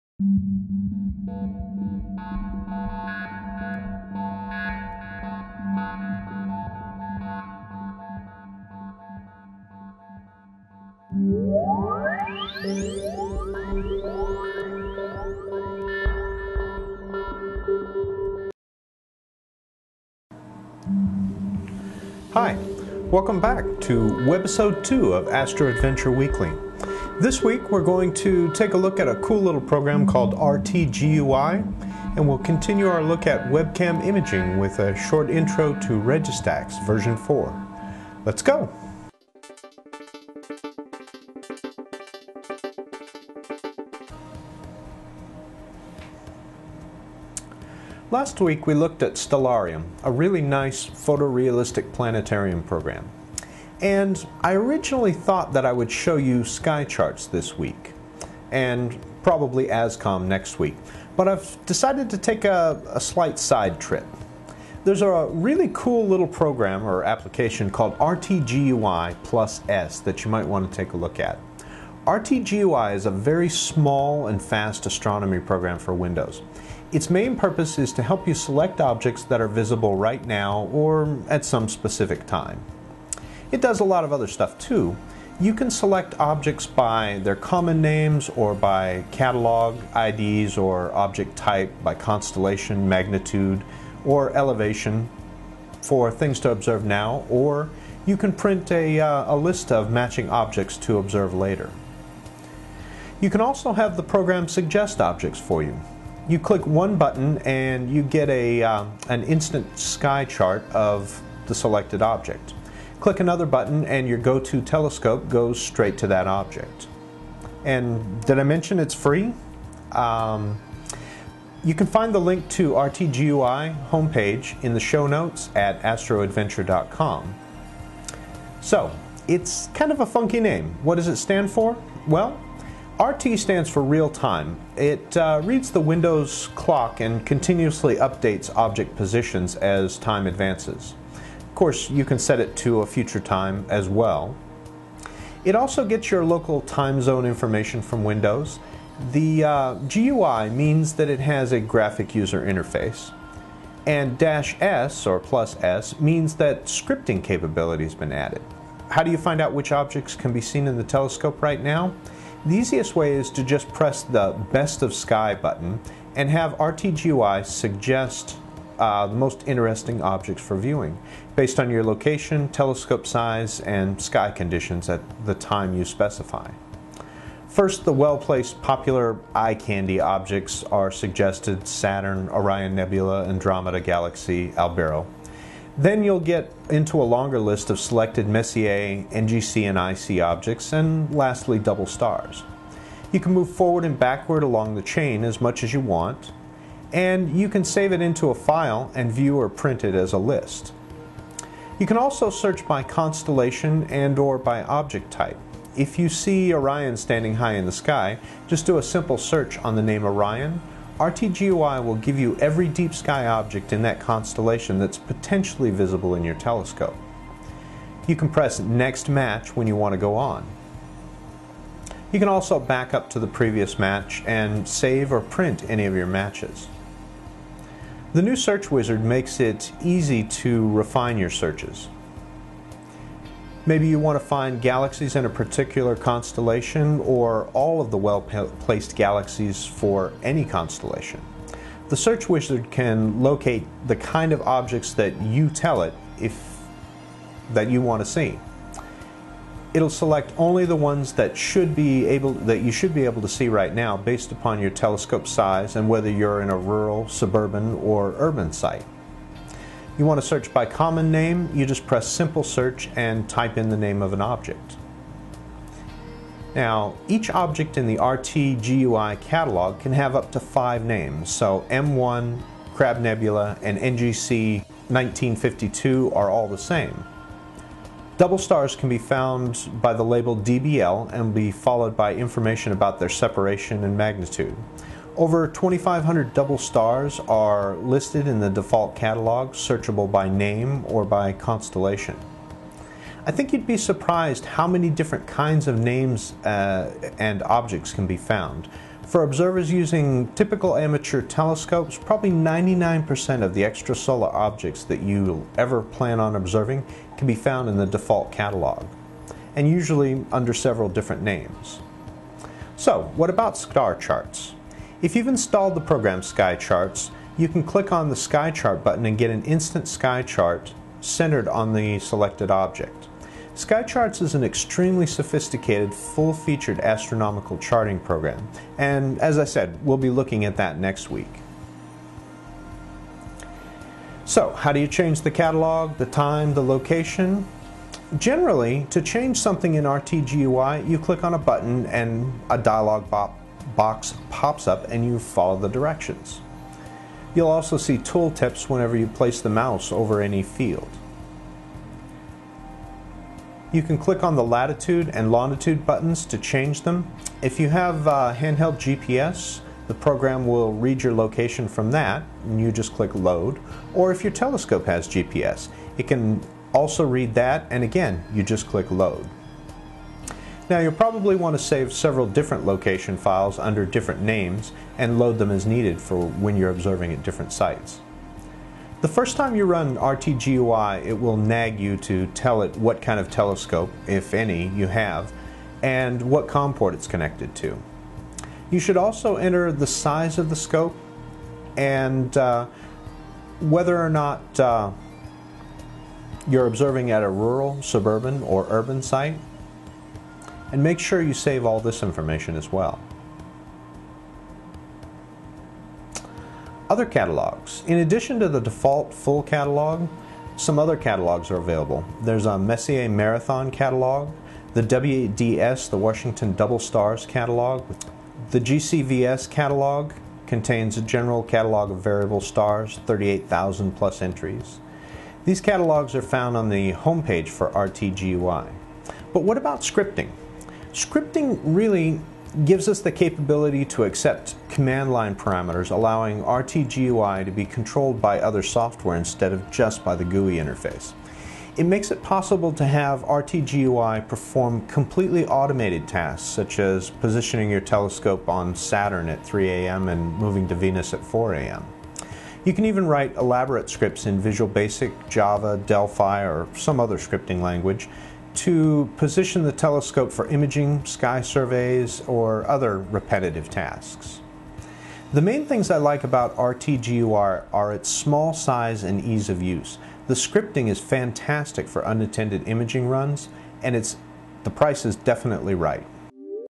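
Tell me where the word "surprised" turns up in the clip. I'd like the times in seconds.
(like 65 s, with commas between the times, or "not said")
293 s.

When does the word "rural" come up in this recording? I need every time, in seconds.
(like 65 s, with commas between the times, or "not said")
256 s, 397 s.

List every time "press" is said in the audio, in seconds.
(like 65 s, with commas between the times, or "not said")
163 s, 218 s, 261 s.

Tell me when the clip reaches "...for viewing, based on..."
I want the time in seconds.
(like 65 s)
170 s.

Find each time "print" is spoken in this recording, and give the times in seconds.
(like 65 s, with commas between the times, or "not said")
98 s, 199 s, 225 s.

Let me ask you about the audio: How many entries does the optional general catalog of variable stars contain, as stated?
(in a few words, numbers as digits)
38,000.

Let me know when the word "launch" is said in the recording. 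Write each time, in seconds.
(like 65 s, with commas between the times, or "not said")
not said.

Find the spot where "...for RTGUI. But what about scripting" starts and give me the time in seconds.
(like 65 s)
427 s.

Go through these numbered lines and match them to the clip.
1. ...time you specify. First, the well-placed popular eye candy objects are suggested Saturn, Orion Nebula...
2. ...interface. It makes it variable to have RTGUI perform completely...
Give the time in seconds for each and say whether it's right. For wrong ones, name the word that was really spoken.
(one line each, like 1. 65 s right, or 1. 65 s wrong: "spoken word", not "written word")
1. 175 s right
2. 440 s wrong: "possible", not "variable".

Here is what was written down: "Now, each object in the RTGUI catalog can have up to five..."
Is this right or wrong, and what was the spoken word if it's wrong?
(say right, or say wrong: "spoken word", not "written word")
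right.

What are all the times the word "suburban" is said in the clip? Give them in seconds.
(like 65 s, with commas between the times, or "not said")
257 s, 397 s.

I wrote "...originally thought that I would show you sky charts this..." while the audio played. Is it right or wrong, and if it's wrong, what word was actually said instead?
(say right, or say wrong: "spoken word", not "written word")
right.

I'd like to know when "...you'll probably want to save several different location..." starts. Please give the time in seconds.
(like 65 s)
370 s.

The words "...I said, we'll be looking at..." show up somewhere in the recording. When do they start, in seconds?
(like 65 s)
329 s.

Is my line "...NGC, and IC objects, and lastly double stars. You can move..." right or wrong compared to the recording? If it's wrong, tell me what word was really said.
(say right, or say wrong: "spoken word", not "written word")
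right.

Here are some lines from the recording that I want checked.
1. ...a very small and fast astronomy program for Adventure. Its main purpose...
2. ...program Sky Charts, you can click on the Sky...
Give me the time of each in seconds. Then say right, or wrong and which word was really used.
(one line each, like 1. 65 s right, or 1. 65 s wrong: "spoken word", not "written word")
1. 73 s wrong: "Windows", not "Adventure"
2. 315 s right.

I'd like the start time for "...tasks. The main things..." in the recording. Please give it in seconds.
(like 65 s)
463 s.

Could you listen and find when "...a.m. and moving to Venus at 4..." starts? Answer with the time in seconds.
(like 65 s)
449 s.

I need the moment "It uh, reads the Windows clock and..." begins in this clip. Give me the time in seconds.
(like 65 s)
134 s.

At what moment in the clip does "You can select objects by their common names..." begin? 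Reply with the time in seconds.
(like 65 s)
85 s.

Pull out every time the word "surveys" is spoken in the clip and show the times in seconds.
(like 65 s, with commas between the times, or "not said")
461 s.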